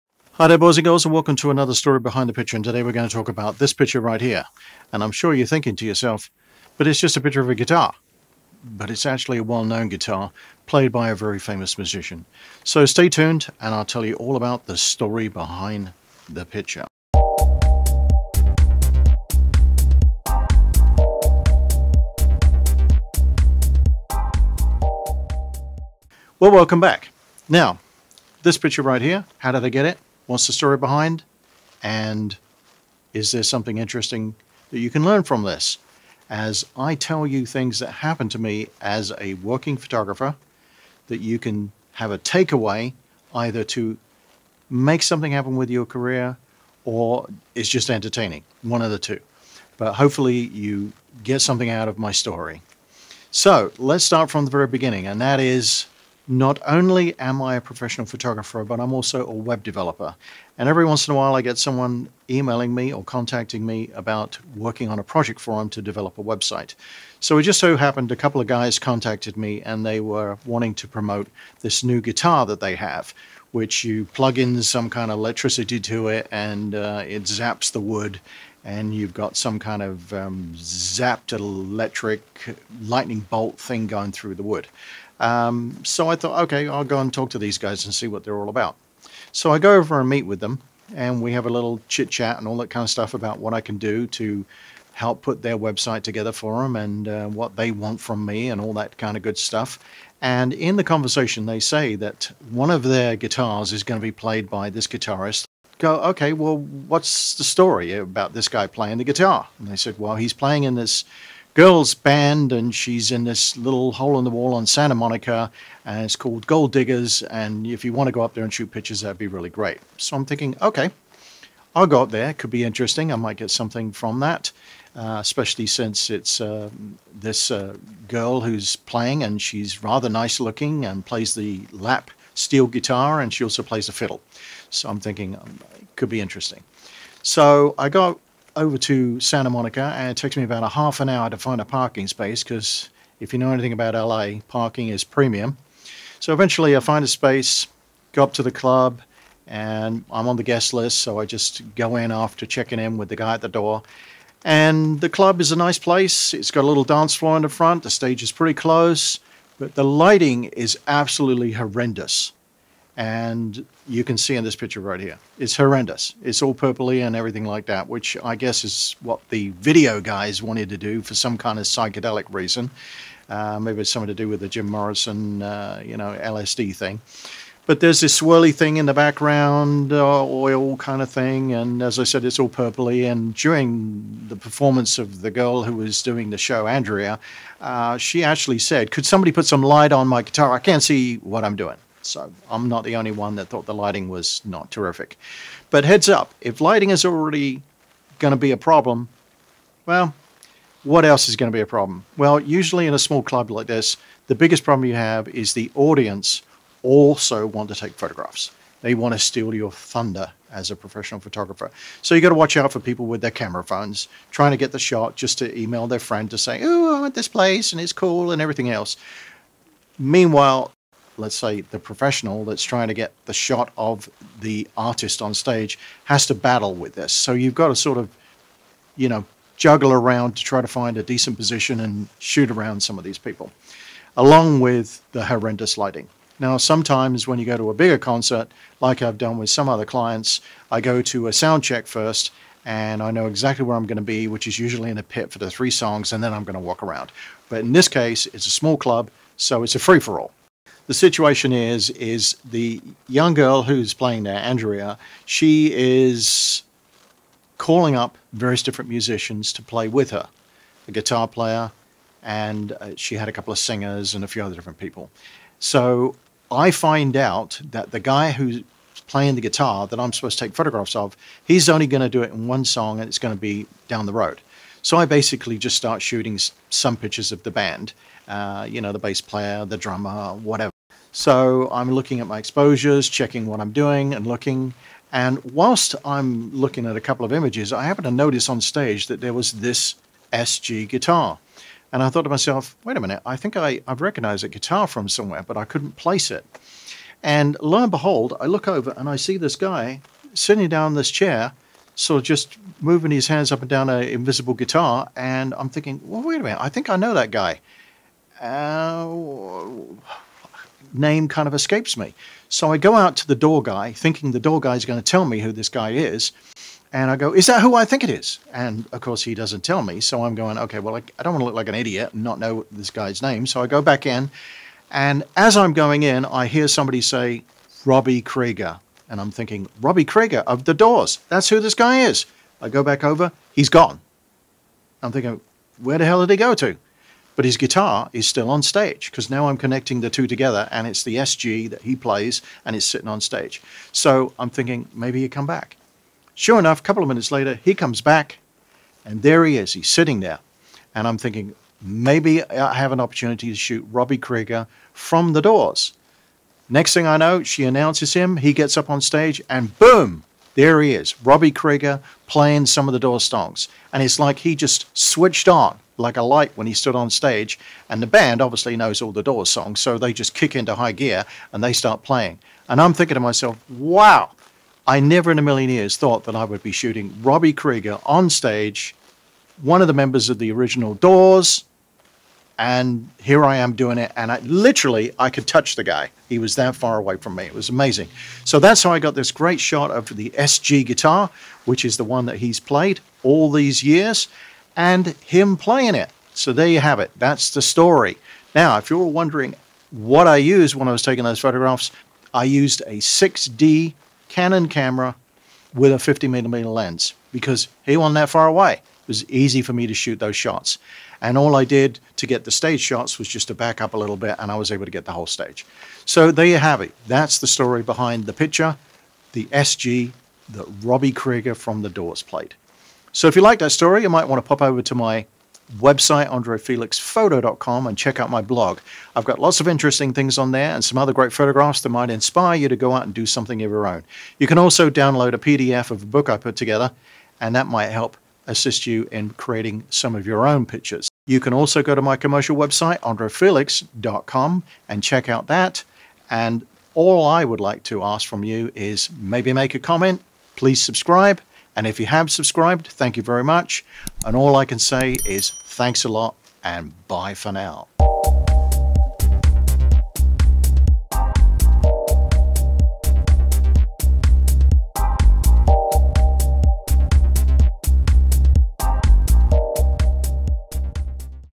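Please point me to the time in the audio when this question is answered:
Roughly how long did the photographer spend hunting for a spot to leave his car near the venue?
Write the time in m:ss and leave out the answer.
2:20.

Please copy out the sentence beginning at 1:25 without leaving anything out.
Um, so I thought, okay, I'll go and talk to these guys and see what they're all about.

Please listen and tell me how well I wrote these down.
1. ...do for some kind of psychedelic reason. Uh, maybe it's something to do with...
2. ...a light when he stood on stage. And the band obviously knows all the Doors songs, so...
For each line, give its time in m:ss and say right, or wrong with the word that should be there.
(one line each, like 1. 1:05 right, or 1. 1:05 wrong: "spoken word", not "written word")
1. 2:50 right
2. 6:06 right.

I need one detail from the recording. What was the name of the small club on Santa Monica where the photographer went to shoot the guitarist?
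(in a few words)
Gold Diggers.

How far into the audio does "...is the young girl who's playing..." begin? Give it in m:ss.
4:11.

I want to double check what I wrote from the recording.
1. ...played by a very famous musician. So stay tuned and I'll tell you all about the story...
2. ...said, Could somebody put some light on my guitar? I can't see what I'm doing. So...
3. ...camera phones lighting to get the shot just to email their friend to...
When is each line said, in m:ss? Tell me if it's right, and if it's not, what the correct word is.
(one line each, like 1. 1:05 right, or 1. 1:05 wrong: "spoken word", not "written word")
1. 0:10 right
2. 3:08 right
3. 3:33 wrong: "trying", not "lighting".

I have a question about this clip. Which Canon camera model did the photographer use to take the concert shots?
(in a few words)
6D.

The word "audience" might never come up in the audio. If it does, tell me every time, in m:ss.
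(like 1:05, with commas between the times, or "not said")
3:25.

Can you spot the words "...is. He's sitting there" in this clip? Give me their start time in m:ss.
5:49.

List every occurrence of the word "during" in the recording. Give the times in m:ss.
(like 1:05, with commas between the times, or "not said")
3:03.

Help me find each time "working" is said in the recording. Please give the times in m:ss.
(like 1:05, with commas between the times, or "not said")
0:39, 1:04.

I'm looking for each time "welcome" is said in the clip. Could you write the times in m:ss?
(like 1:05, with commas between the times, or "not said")
0:01, 0:26.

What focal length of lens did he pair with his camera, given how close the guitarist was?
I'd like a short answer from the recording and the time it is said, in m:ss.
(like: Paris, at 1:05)
50 millimeter, at 6:45.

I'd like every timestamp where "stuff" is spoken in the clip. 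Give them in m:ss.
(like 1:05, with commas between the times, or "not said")
1:32, 1:39.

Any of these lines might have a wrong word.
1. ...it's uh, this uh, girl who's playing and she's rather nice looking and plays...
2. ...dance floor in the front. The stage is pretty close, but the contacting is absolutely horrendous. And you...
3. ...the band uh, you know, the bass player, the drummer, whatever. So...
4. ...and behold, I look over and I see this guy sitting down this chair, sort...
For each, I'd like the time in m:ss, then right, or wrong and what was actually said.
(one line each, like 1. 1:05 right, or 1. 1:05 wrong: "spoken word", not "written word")
1. 2:06 right
2. 2:36 wrong: "lighting", not "contacting"
3. 4:37 right
4. 4:57 right.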